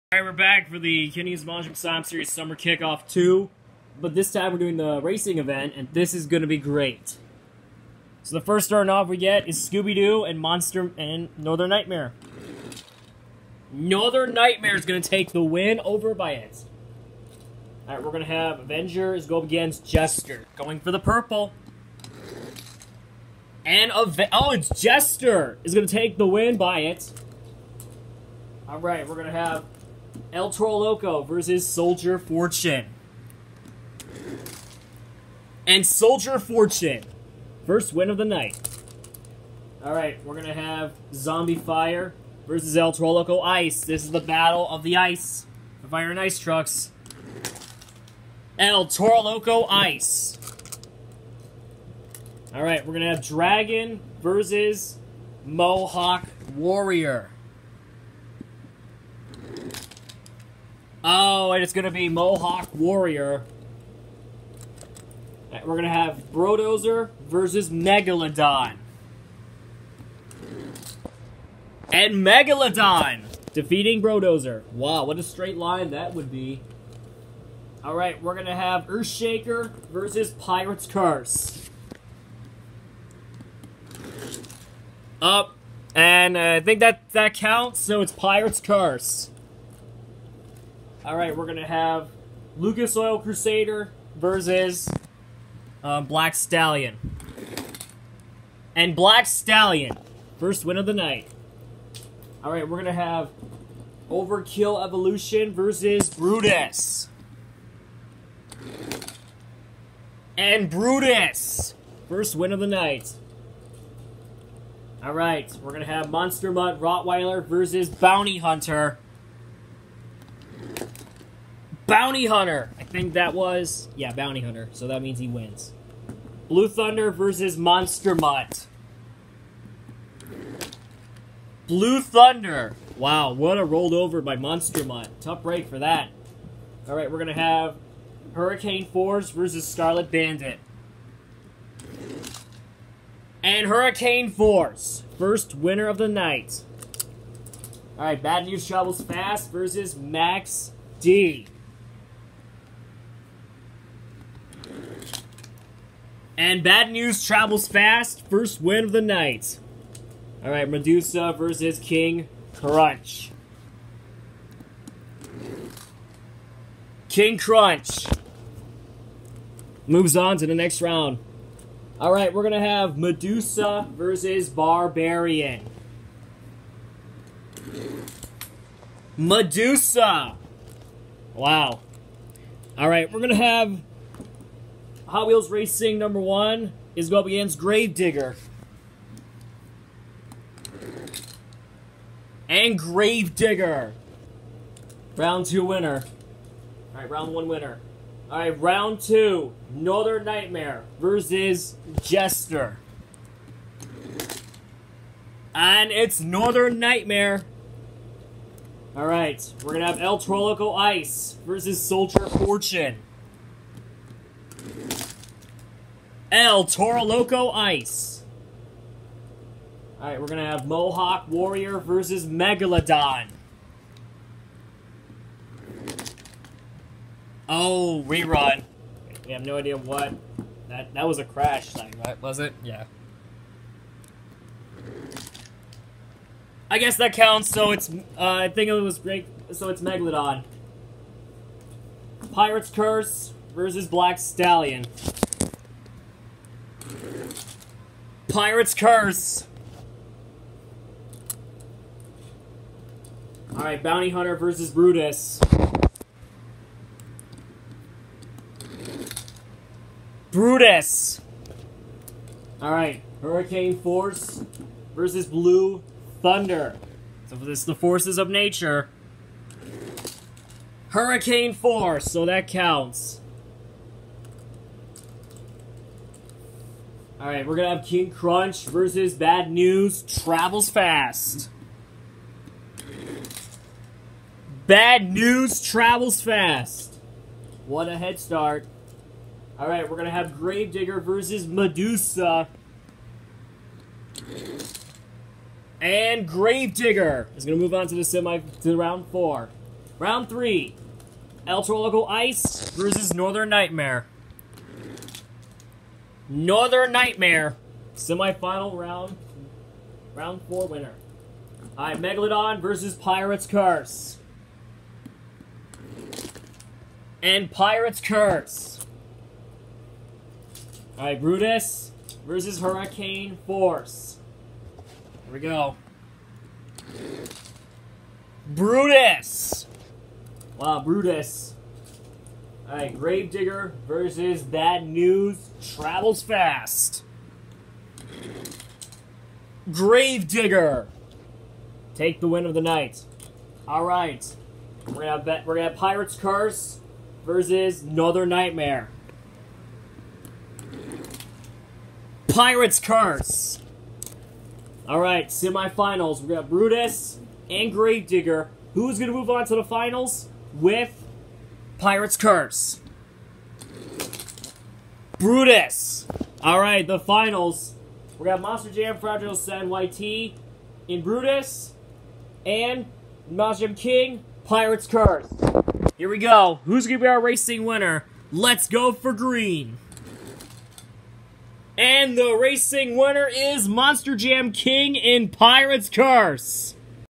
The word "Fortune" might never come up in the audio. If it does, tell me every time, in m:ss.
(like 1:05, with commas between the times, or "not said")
0:32, 0:36, 3:32.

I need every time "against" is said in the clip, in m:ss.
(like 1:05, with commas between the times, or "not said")
0:19, 3:07.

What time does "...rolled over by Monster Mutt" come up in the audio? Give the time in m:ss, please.
2:13.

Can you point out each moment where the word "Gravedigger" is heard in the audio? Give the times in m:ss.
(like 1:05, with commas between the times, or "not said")
3:07, 3:12, 4:50, 4:56, 5:32, 5:39, 5:57.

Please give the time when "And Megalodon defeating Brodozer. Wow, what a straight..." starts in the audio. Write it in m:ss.
1:11.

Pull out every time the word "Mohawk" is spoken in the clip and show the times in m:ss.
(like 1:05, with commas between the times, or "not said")
0:55, 1:02, 3:40.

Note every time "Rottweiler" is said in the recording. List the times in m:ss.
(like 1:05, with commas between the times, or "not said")
1:56.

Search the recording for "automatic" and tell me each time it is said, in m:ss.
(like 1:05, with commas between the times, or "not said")
not said.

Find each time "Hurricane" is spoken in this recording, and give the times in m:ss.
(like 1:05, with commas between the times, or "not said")
2:18, 2:23, 4:23, 4:30, 5:22.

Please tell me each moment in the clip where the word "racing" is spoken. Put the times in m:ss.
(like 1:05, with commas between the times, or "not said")
0:04, 3:05, 6:17, 6:22.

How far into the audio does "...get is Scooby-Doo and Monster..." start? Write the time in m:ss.
0:09.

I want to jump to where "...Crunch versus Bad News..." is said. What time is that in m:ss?
4:38.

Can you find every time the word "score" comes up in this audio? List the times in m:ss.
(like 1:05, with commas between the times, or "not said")
not said.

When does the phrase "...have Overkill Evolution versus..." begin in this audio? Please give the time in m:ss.
1:42.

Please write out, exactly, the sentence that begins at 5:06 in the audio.
Northern Nightmare, semifinal round, round four winner.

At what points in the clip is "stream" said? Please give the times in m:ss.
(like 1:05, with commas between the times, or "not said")
not said.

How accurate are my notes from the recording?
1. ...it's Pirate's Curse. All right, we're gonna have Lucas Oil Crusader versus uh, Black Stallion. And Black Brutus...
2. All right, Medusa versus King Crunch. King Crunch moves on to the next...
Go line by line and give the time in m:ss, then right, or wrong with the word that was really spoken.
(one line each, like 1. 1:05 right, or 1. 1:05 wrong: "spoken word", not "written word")
1. 1:28 wrong: "Stallion", not "Brutus"
2. 2:40 right.